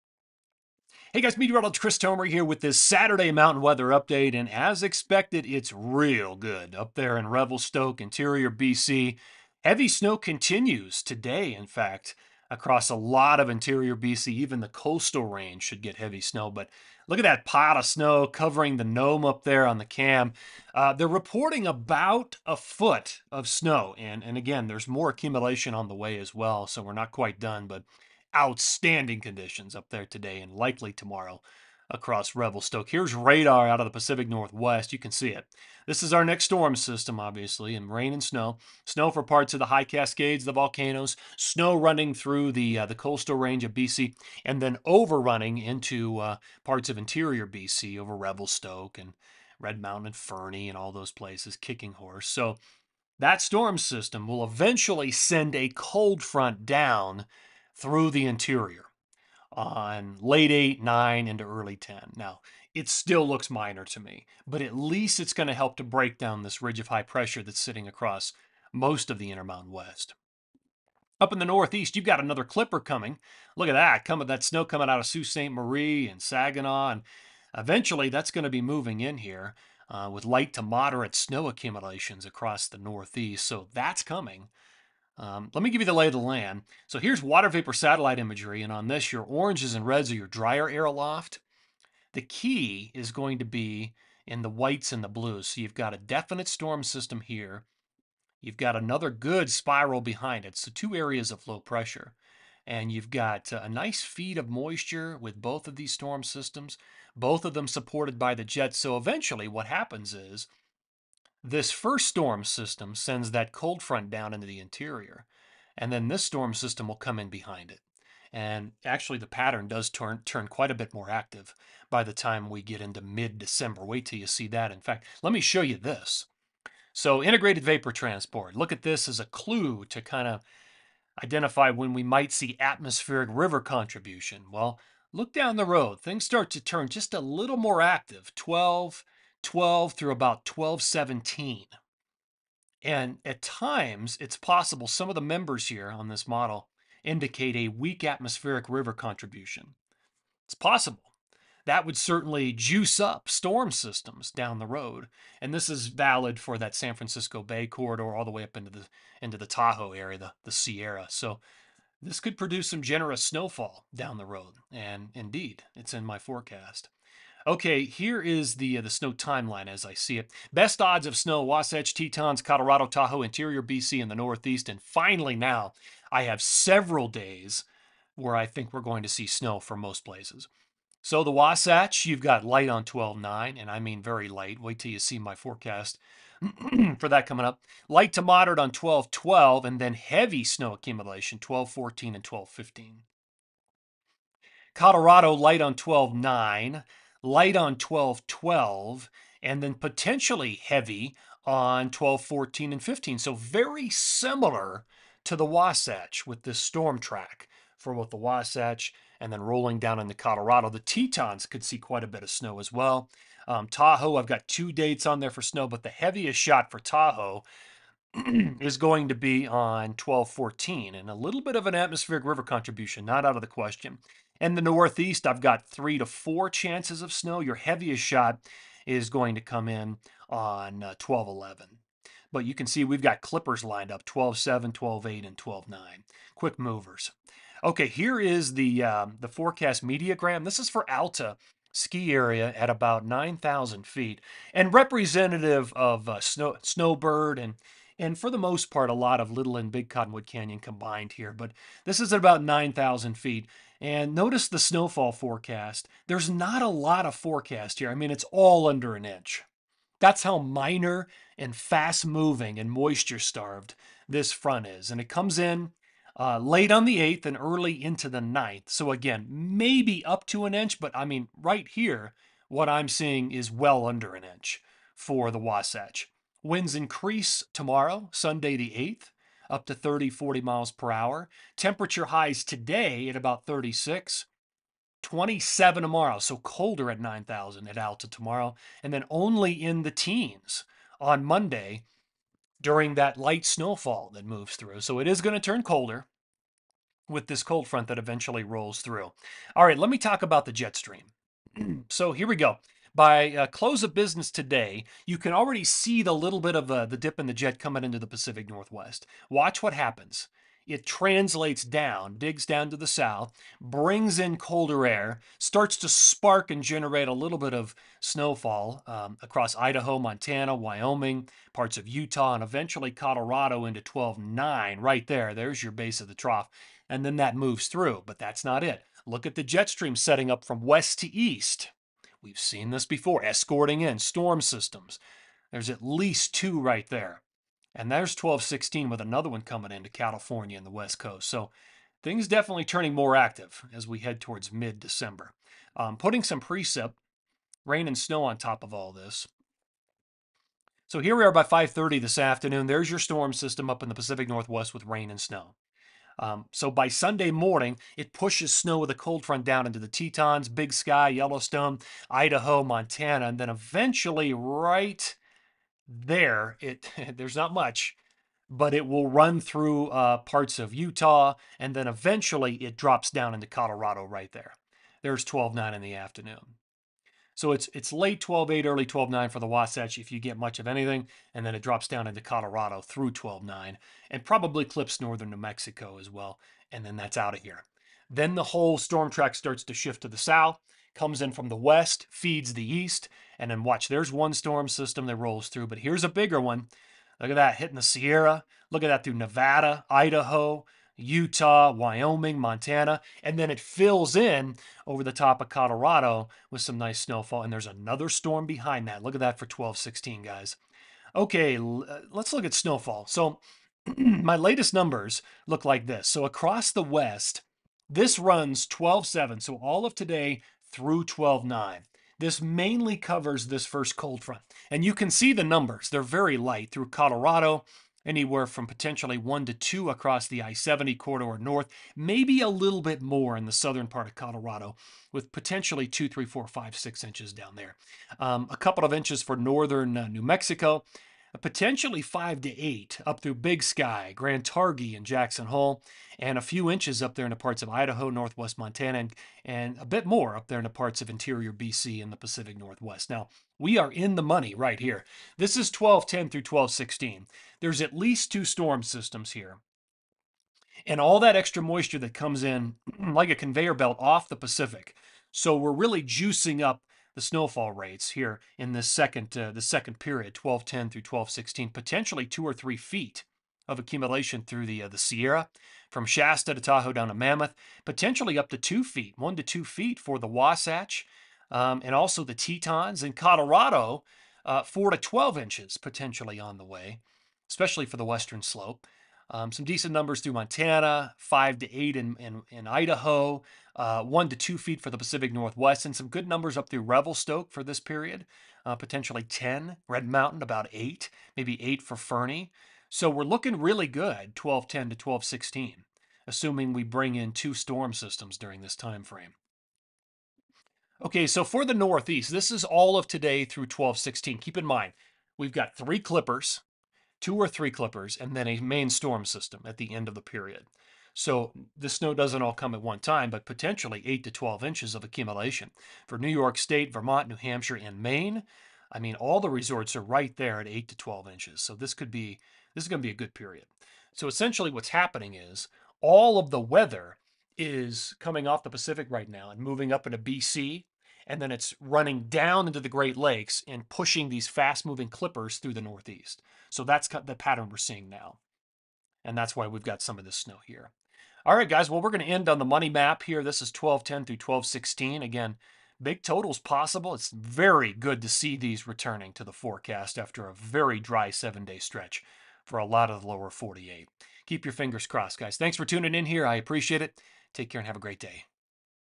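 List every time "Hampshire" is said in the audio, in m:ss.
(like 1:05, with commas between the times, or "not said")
8:47.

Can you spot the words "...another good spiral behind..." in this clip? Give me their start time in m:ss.
1:38.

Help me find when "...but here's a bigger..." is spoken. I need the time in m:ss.
6:35.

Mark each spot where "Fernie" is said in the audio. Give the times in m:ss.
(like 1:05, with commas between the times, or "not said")
0:50, 8:21.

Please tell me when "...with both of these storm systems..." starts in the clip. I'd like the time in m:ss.
1:45.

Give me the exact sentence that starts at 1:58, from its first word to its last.
And actually, the pattern does turn turn quite a bit more active by the time we get into mid-December.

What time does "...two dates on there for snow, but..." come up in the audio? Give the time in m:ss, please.
3:34.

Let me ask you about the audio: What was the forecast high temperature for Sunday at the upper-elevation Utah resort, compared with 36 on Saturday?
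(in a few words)
27.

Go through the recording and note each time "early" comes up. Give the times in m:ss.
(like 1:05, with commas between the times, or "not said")
1:01, 4:27, 6:18.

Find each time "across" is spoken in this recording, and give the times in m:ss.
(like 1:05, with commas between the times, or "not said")
0:12, 0:31, 1:07, 1:22, 5:19, 6:56, 7:09.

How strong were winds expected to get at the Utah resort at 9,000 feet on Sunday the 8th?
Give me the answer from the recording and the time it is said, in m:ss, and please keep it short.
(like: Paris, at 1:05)
30-40 mph, at 4:39.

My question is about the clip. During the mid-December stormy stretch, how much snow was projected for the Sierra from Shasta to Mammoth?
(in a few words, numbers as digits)
2 or 3 feet.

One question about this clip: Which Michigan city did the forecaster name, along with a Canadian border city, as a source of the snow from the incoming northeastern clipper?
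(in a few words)
Saginaw.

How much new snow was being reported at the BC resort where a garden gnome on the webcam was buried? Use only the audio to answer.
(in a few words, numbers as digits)
about a foot.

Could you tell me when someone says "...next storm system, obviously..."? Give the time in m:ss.
0:36.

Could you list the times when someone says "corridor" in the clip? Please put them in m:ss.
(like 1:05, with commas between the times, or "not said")
2:37, 7:10.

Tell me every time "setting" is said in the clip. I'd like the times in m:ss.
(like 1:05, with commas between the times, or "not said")
5:29.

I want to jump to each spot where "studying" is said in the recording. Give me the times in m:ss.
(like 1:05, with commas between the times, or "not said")
not said.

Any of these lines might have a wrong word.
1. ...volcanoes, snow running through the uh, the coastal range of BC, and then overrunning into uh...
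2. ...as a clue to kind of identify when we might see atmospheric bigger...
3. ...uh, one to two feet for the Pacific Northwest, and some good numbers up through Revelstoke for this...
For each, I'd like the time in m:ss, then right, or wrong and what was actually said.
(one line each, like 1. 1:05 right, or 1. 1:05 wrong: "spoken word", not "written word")
1. 0:40 right
2. 2:09 wrong: "river", not "bigger"
3. 8:13 right.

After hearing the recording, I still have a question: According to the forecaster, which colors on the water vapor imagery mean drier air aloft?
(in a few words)
oranges and reds.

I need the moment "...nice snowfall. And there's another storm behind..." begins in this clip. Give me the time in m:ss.
6:46.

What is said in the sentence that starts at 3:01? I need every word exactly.
So the Wasatch, you've got light on 12.9, and I mean very light.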